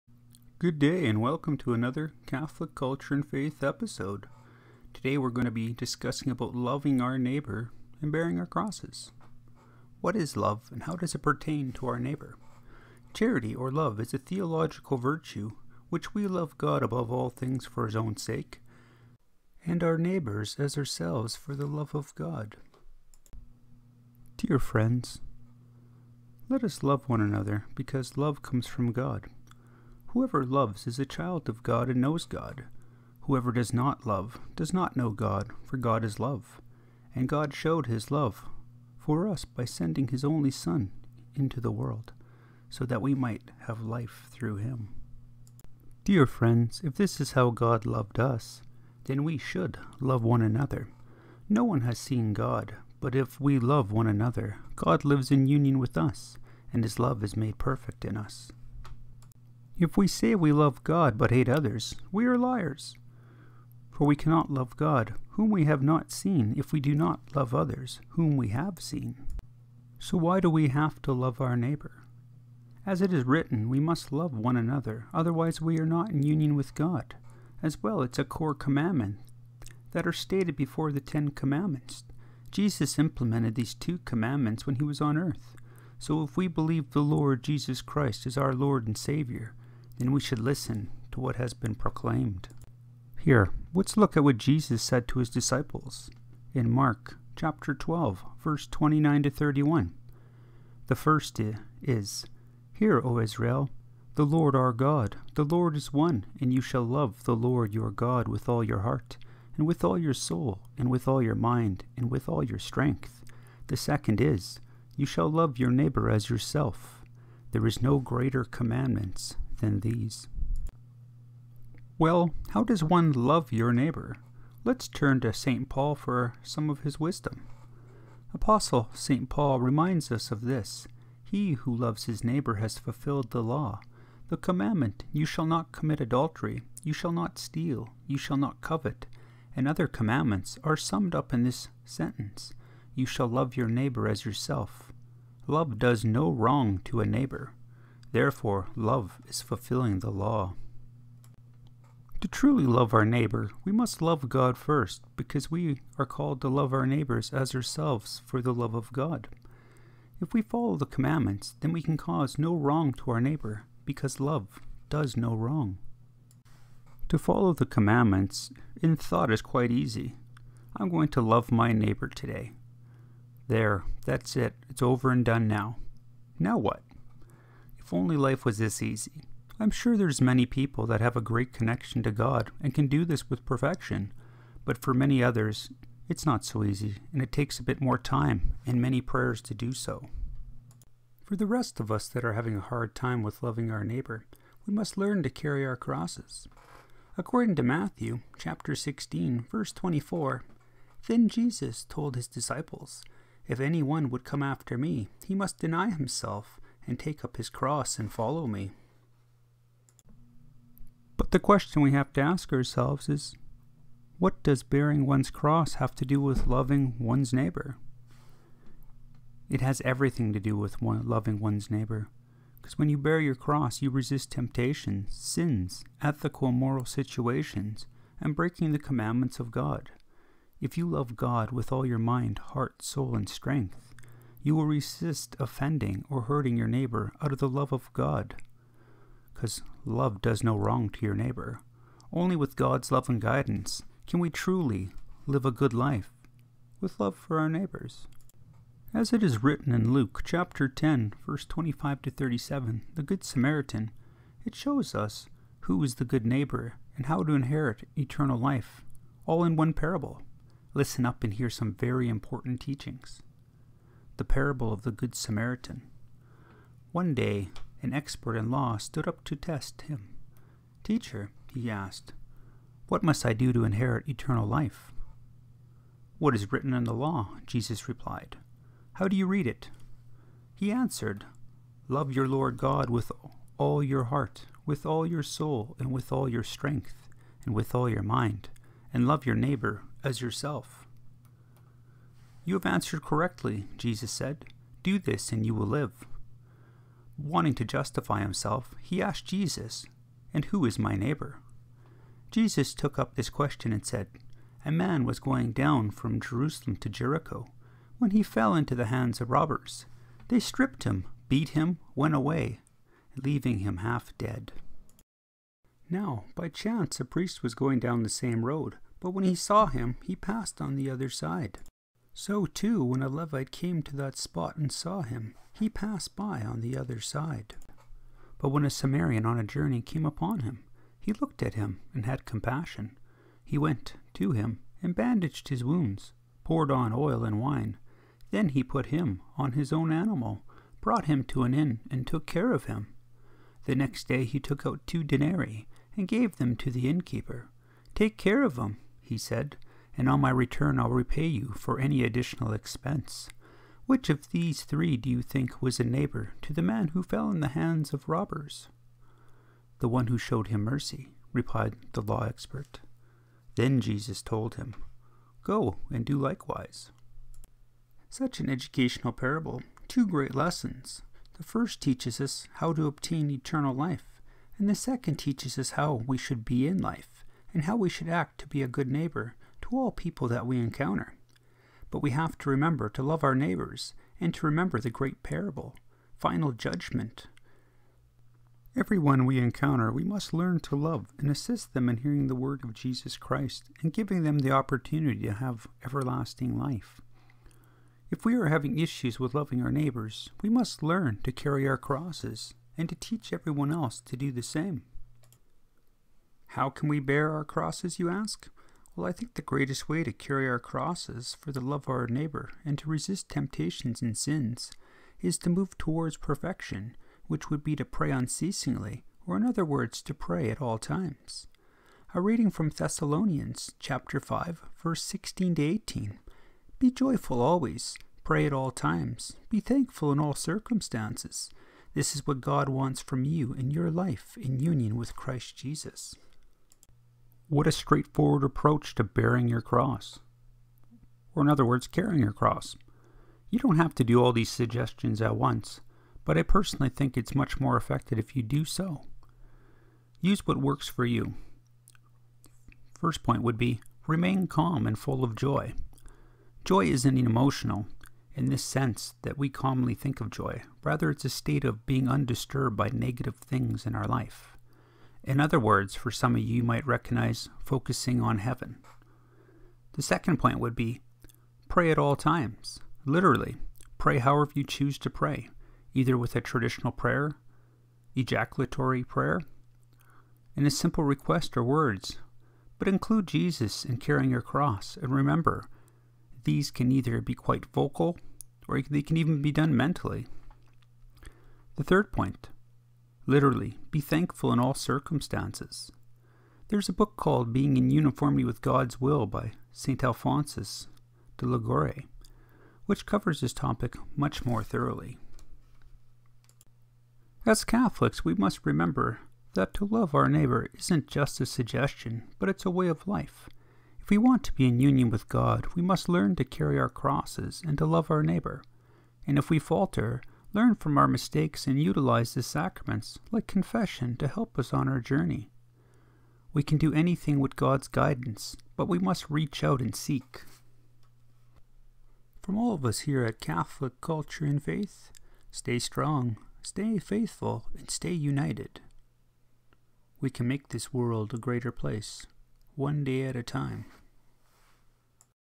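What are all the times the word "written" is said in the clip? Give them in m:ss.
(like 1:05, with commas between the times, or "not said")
1:13, 4:09, 4:36.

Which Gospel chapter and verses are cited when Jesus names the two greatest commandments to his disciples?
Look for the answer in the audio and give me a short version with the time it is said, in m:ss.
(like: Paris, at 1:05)
Mark 12:29-31, at 1:36.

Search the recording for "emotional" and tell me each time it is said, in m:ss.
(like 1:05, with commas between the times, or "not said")
7:37.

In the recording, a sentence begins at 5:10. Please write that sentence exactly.
They stripped him, beat him, went away, leaving him half dead.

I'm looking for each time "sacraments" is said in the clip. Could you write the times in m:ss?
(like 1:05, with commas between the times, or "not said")
8:42.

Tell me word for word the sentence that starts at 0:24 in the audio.
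Dear friends, let us love one another because love comes from God.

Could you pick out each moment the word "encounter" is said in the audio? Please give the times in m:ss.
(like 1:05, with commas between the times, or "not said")
6:20, 6:29.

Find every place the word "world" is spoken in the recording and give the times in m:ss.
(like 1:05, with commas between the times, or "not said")
0:41, 9:00.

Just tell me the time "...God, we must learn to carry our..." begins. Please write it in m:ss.
8:35.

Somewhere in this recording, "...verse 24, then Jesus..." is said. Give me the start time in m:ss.
3:19.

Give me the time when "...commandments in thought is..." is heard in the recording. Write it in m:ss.
2:47.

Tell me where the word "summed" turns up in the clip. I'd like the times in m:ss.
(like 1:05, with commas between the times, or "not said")
2:20.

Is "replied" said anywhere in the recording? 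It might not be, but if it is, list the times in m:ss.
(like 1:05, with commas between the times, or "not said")
4:37, 6:01.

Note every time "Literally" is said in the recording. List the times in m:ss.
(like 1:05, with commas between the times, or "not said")
7:53, 8:13.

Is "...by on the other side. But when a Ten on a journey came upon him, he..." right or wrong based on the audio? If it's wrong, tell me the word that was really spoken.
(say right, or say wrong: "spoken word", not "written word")
wrong: "Samaritan", not "Ten".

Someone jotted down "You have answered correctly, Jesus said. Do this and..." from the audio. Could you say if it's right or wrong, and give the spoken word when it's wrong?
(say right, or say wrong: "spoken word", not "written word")
right.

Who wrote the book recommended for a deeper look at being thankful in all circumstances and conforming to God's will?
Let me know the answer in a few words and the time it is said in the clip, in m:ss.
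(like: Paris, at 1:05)
St. Alphonsus de Liguori, at 8:19.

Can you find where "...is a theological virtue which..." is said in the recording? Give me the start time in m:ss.
0:13.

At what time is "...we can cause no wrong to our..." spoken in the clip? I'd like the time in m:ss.
2:41.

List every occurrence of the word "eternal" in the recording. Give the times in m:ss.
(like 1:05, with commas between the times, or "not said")
4:17, 4:34, 6:13.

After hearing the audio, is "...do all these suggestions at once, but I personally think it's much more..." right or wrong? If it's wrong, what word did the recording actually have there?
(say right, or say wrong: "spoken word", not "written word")
right.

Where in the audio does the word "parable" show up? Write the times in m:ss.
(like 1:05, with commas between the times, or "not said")
4:19, 4:24, 6:09, 6:25.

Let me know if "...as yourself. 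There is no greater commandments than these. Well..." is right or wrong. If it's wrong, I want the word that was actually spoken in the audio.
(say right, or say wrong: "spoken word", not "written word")
right.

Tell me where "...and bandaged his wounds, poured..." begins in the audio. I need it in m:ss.
5:34.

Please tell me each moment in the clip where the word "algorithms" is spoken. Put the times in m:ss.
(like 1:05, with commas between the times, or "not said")
not said.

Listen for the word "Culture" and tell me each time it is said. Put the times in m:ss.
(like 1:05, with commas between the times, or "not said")
0:02, 8:54.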